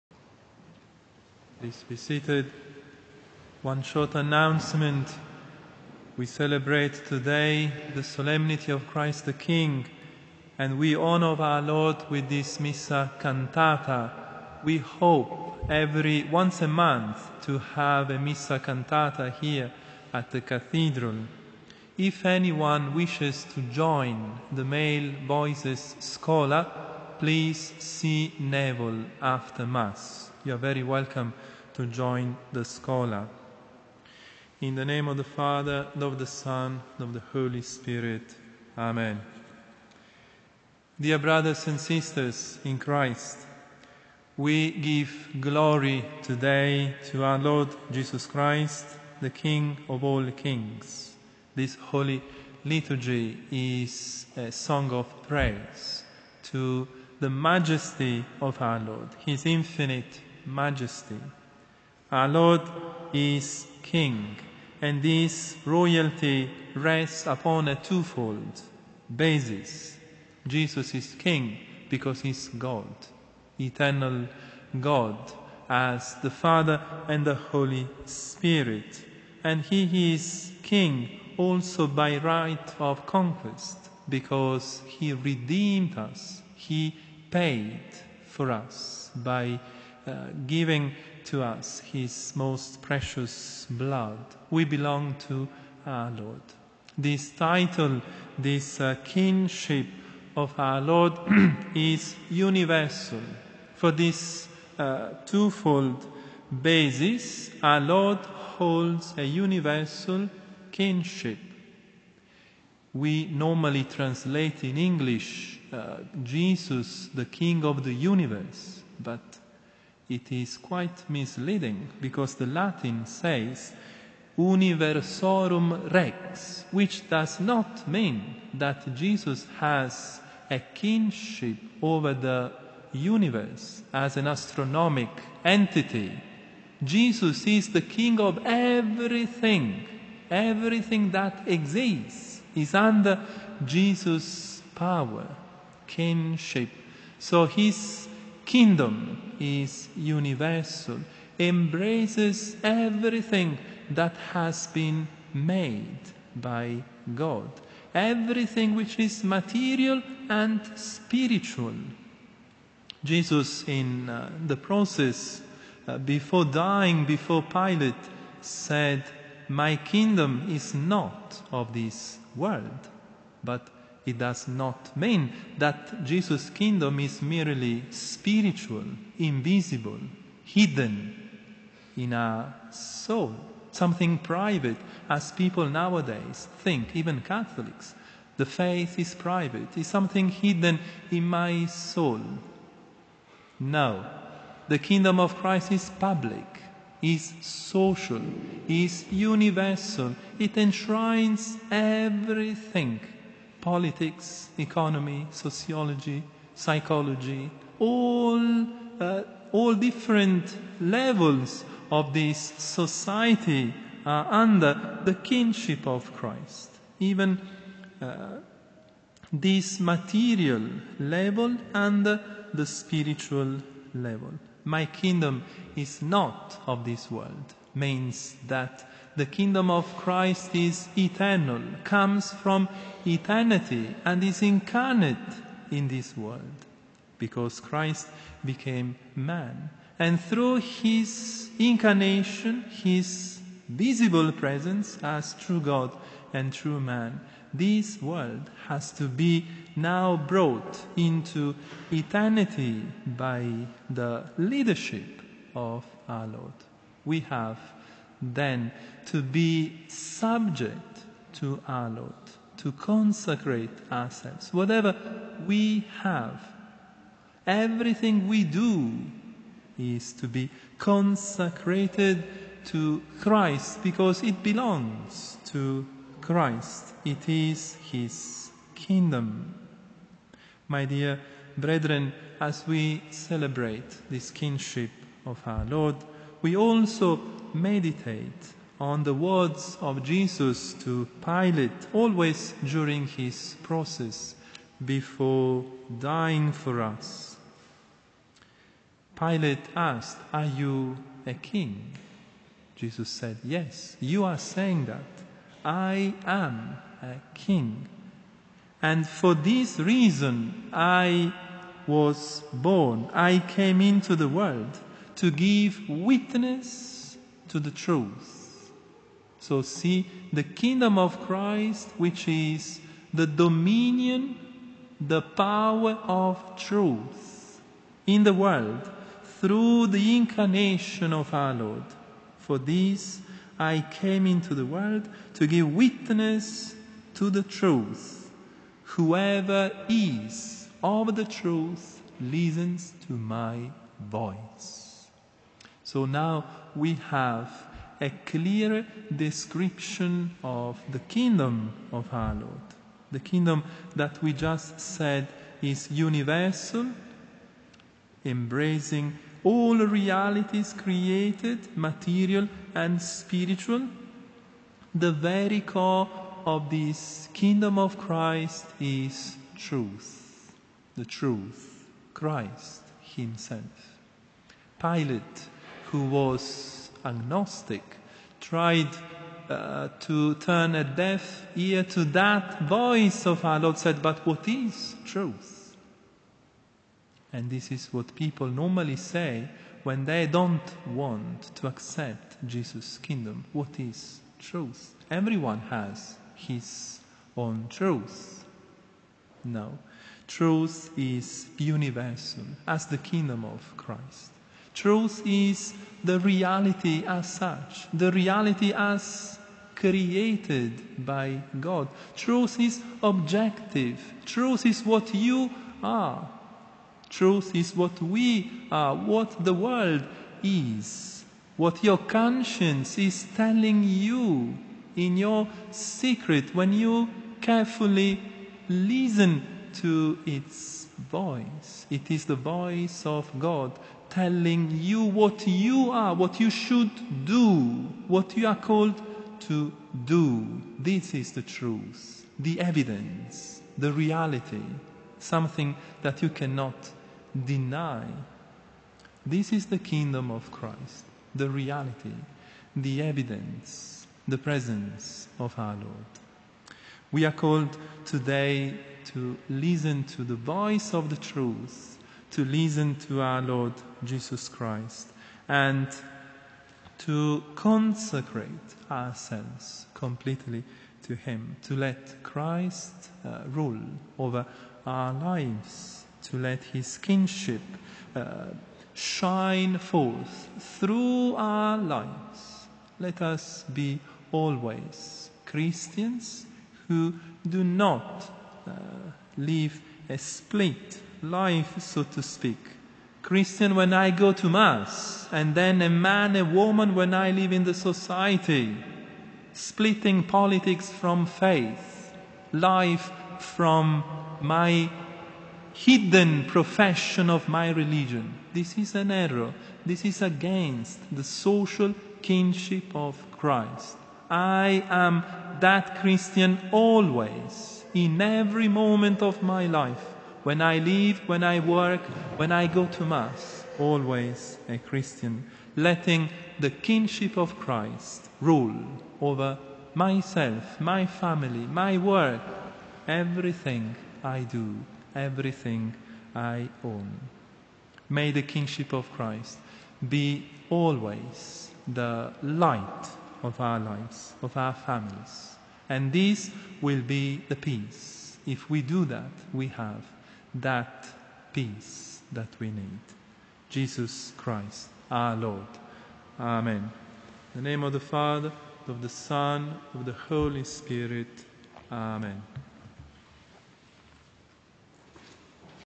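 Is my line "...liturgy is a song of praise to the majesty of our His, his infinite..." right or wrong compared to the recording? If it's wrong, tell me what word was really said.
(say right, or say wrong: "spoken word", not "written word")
wrong: "Lord", not "His".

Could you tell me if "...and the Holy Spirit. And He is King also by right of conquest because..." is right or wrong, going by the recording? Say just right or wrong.
right.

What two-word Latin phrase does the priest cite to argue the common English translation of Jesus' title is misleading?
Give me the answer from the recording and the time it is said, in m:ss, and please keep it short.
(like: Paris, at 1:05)
universorum rex, at 2:04.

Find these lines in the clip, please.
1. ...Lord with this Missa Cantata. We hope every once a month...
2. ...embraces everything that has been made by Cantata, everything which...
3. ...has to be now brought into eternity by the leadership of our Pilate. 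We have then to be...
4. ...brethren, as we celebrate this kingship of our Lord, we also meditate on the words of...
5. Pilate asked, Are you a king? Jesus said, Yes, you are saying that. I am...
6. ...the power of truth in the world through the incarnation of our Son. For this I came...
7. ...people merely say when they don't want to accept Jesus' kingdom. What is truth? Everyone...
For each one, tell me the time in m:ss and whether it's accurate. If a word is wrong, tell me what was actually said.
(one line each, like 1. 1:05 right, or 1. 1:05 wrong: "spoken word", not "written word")
1. 0:11 right
2. 2:31 wrong: "God", not "Cantata"
3. 4:08 wrong: "Lord", not "Pilate"
4. 4:41 right
5. 4:59 right
6. 5:24 wrong: "Lord", not "Son"
7. 6:28 wrong: "normally", not "merely".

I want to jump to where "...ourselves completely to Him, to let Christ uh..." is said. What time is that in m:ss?
7:48.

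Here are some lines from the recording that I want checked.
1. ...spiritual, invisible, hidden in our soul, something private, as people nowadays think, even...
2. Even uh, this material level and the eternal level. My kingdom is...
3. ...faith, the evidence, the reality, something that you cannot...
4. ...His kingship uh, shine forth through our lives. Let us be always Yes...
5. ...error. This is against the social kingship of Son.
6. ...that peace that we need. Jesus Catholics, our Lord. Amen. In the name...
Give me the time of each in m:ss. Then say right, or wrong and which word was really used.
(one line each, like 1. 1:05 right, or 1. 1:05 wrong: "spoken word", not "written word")
1. 2:57 right
2. 3:36 wrong: "spiritual", not "eternal"
3. 7:21 wrong: "truth", not "faith"
4. 7:56 wrong: "Christians", not "Yes"
5. 8:29 wrong: "Christ", not "Son"
6. 9:10 wrong: "Christ", not "Catholics".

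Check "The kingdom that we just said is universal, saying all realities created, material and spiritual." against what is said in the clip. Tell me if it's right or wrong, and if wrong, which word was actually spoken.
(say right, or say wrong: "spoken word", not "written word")
wrong: "embracing", not "saying".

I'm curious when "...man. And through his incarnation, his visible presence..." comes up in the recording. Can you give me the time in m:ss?
3:59.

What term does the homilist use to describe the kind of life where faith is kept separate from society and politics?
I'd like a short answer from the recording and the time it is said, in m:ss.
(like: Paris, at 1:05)
A split life, at 8:10.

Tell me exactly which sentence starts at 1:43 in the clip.
For this uh, twofold basis, our Lord holds a universal kinship.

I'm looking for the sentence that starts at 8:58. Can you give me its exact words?
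May the kingship of Christ be always the light of our lives, of our families.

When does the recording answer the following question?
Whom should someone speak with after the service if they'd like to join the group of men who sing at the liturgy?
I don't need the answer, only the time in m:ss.
0:28.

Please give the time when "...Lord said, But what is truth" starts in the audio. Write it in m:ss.
6:23.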